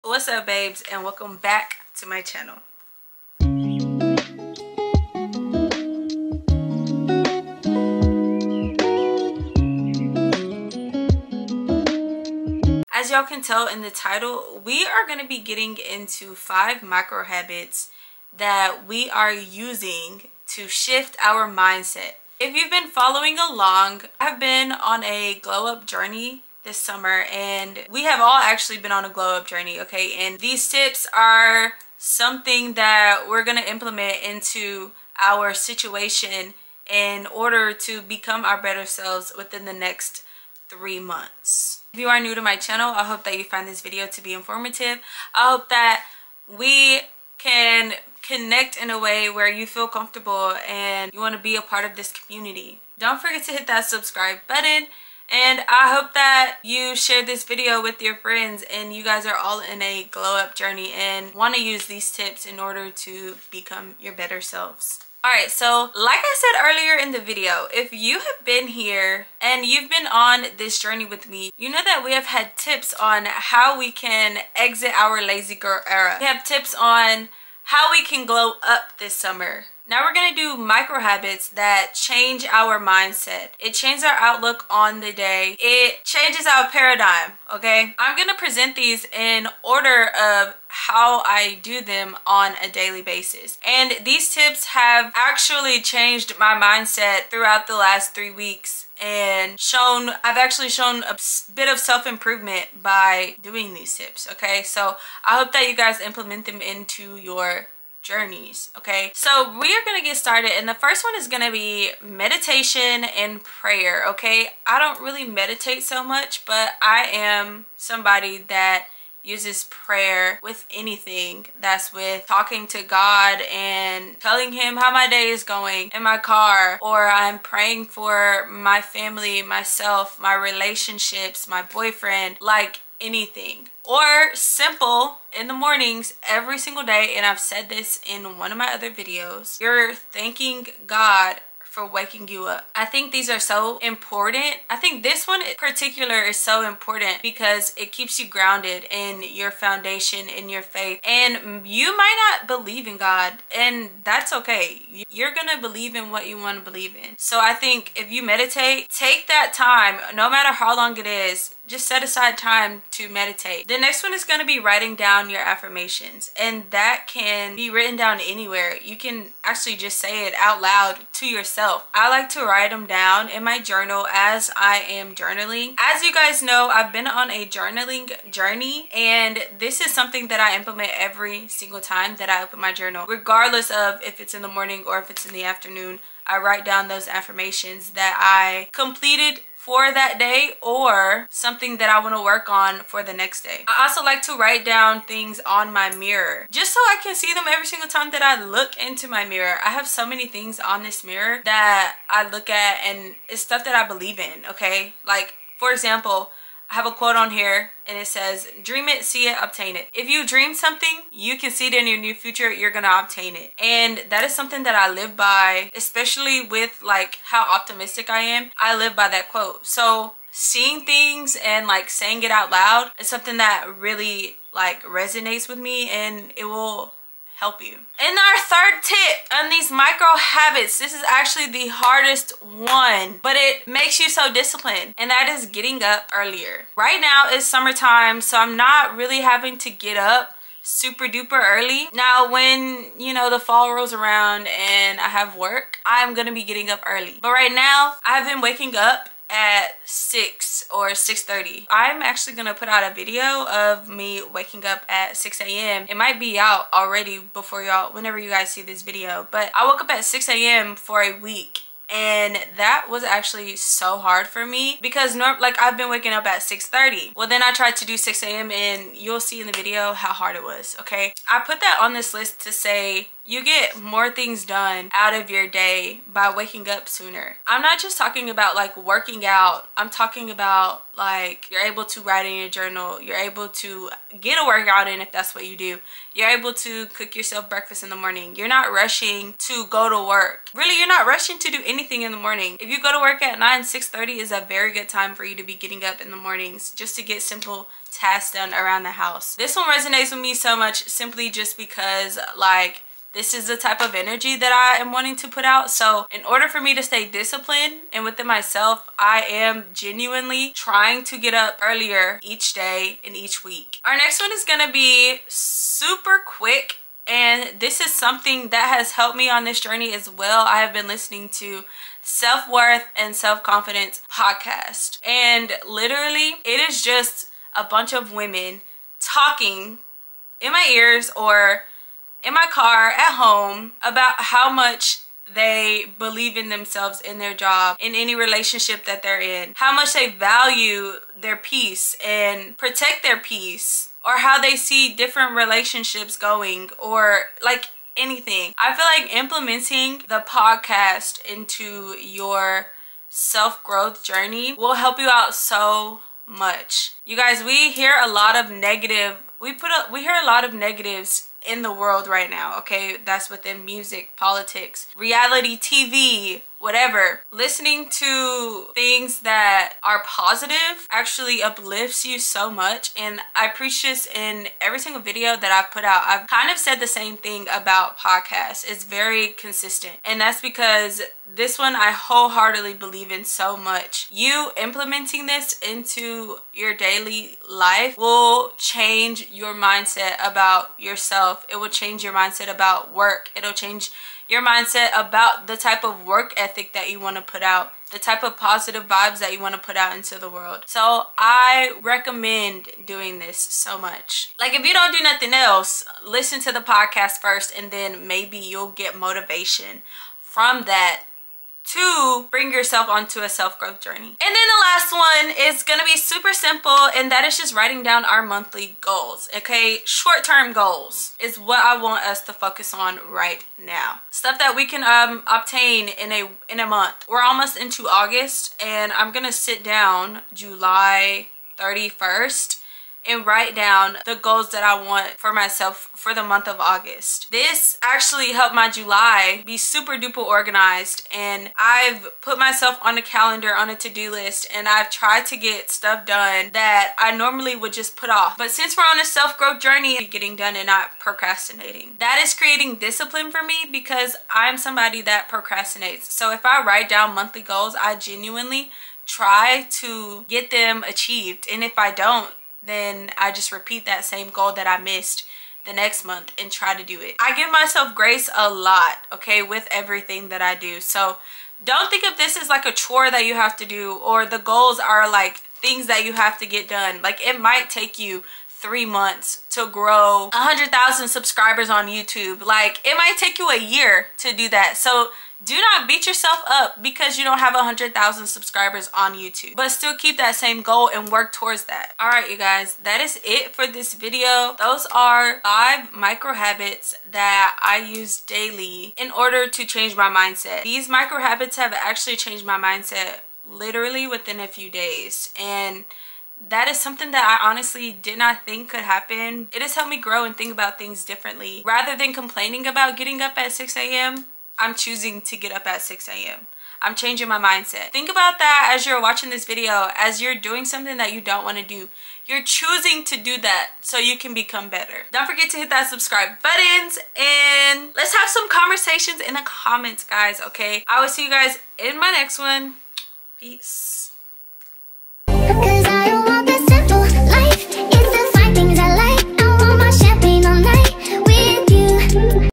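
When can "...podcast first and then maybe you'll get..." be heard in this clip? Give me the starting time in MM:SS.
06:46.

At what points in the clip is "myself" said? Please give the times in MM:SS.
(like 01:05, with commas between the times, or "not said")
02:09, 05:08, 07:15, 07:22, 07:47.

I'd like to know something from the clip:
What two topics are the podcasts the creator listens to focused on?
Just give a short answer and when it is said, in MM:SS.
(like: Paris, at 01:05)
Self-worth and self-confidence, at 05:22.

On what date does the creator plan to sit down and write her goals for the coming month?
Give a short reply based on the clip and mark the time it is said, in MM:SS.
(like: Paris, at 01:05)
July 31st, at 07:10.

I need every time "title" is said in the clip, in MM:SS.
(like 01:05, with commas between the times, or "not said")
00:13.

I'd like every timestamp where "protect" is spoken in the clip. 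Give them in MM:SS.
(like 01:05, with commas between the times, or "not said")
05:42.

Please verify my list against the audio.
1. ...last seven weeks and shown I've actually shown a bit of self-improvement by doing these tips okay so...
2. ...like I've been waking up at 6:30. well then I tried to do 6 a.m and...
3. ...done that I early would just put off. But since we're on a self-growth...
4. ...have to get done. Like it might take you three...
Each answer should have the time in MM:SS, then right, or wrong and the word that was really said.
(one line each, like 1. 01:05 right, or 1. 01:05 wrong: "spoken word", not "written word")
1. 01:37 wrong: "three", not "seven"
2. 04:25 right
3. 07:26 wrong: "normally", not "early"
4. 07:56 right.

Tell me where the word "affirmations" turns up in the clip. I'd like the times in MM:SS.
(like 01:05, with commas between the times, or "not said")
02:45, 03:07.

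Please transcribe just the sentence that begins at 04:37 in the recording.
I'm not just talking about like working out.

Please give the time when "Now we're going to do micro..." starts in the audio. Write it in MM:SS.
01:19.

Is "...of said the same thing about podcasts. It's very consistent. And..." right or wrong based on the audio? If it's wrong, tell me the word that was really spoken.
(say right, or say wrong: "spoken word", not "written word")
right.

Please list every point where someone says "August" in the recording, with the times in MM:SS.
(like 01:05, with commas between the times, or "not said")
07:07, 07:16.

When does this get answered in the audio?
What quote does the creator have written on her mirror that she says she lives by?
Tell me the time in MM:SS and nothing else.
03:28.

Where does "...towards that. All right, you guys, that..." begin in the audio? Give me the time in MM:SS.
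08:11.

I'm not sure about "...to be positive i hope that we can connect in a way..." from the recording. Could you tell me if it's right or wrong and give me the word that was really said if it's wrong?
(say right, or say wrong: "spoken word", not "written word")
wrong: "informative", not "positive".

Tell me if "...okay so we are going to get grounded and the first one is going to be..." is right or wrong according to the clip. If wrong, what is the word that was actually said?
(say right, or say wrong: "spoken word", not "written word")
wrong: "started", not "grounded".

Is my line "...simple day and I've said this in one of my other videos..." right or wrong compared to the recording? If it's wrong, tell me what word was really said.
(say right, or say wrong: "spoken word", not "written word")
wrong: "single", not "simple".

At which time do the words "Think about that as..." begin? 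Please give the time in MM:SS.
08:37.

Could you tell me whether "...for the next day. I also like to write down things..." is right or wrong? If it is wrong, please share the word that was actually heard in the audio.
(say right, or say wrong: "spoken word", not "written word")
right.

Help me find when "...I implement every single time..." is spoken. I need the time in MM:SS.
03:00.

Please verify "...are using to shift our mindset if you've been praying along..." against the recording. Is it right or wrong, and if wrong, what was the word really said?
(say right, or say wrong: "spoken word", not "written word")
wrong: "following", not "praying".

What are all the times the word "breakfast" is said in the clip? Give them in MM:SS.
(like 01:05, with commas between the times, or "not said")
04:47.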